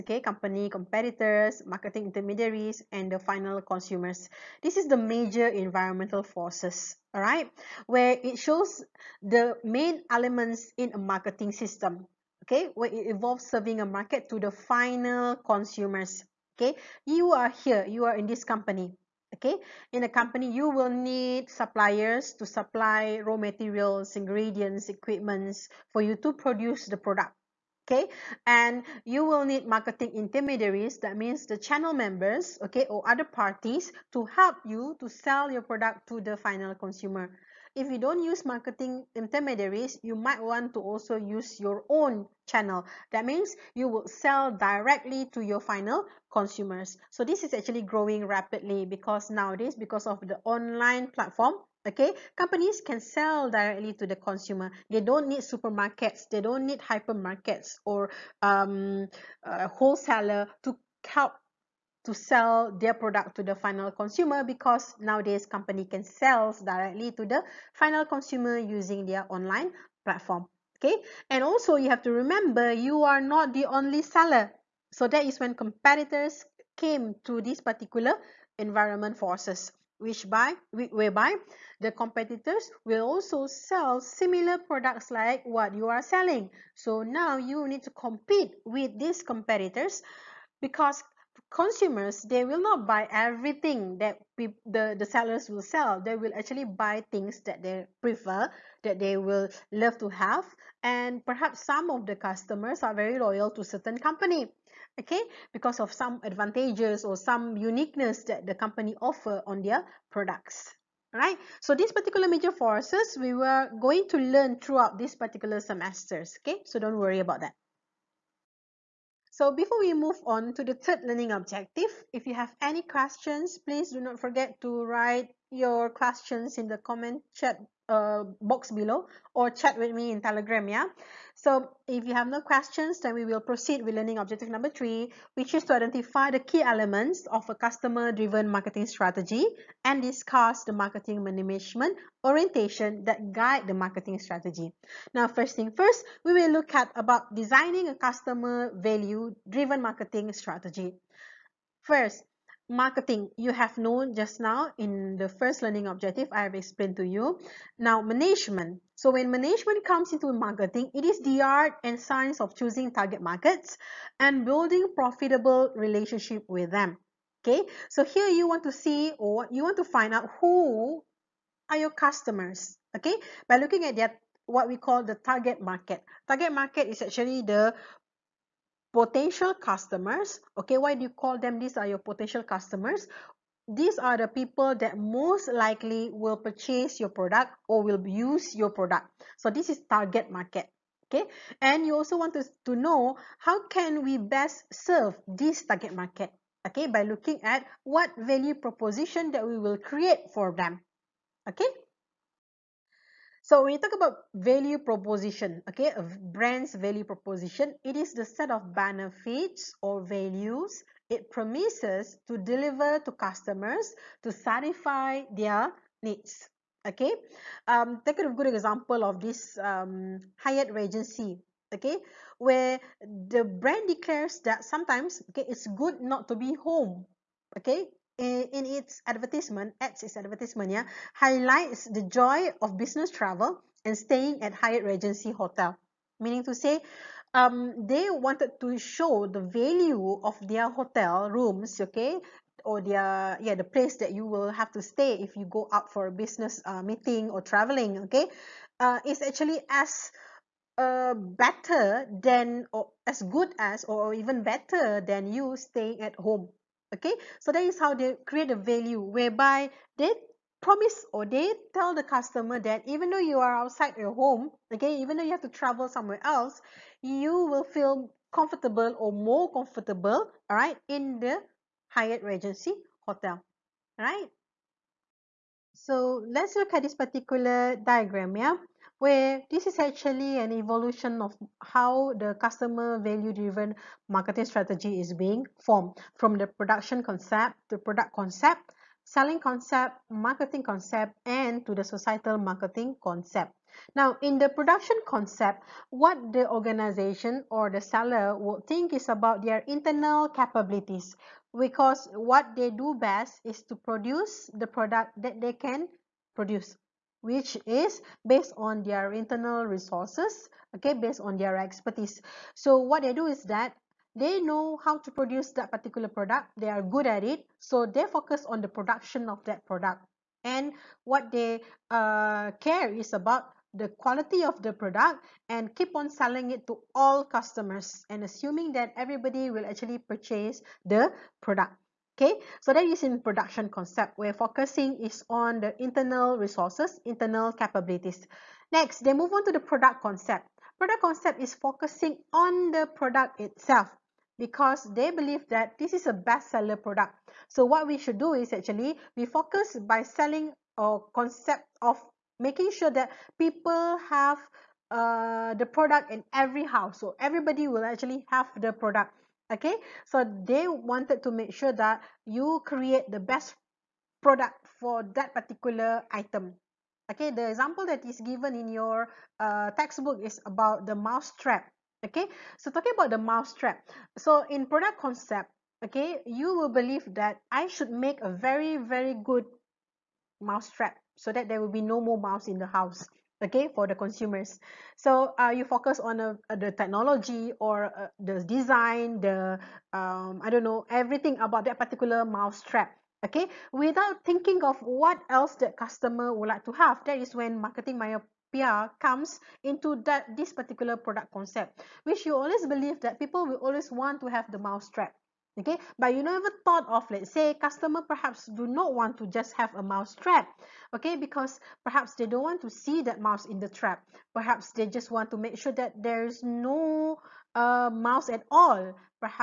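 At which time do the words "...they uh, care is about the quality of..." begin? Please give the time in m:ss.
5:21.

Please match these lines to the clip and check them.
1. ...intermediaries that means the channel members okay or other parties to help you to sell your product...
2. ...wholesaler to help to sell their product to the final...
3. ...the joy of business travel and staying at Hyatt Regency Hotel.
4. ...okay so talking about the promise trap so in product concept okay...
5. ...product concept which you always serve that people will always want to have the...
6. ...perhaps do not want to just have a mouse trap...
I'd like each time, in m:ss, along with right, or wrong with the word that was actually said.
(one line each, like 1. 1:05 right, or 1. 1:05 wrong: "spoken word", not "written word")
1. 0:30 right
2. 0:59 right
3. 3:51 right
4. 6:12 wrong: "mouse", not "promise"
5. 6:40 wrong: "believe", not "serve"
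6. 6:48 right.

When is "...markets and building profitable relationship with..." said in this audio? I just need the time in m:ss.
2:43.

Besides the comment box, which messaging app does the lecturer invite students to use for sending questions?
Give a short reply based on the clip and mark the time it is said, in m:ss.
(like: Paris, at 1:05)
Telegram, at 2:10.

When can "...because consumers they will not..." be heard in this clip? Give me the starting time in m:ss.
1:30.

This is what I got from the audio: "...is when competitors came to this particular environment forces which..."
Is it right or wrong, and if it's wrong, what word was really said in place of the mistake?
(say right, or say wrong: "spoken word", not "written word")
right.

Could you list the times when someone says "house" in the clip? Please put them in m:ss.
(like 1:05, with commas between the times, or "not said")
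5:56, 6:22.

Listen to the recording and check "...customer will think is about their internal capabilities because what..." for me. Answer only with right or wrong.
wrong.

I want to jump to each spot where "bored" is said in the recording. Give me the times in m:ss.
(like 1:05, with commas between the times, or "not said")
not said.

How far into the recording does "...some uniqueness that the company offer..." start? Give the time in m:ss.
1:47.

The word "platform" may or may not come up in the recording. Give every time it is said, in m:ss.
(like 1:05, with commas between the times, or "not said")
0:51, 1:10.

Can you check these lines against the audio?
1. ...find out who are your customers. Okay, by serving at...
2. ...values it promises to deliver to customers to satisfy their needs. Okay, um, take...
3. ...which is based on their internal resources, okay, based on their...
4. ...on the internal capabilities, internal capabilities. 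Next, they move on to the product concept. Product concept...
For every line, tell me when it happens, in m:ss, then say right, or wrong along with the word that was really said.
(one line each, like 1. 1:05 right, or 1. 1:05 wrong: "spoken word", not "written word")
1. 2:49 wrong: "looking", not "serving"
2. 3:30 right
3. 5:07 right
4. 5:35 wrong: "resources", not "capabilities".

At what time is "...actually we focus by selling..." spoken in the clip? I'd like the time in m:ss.
5:48.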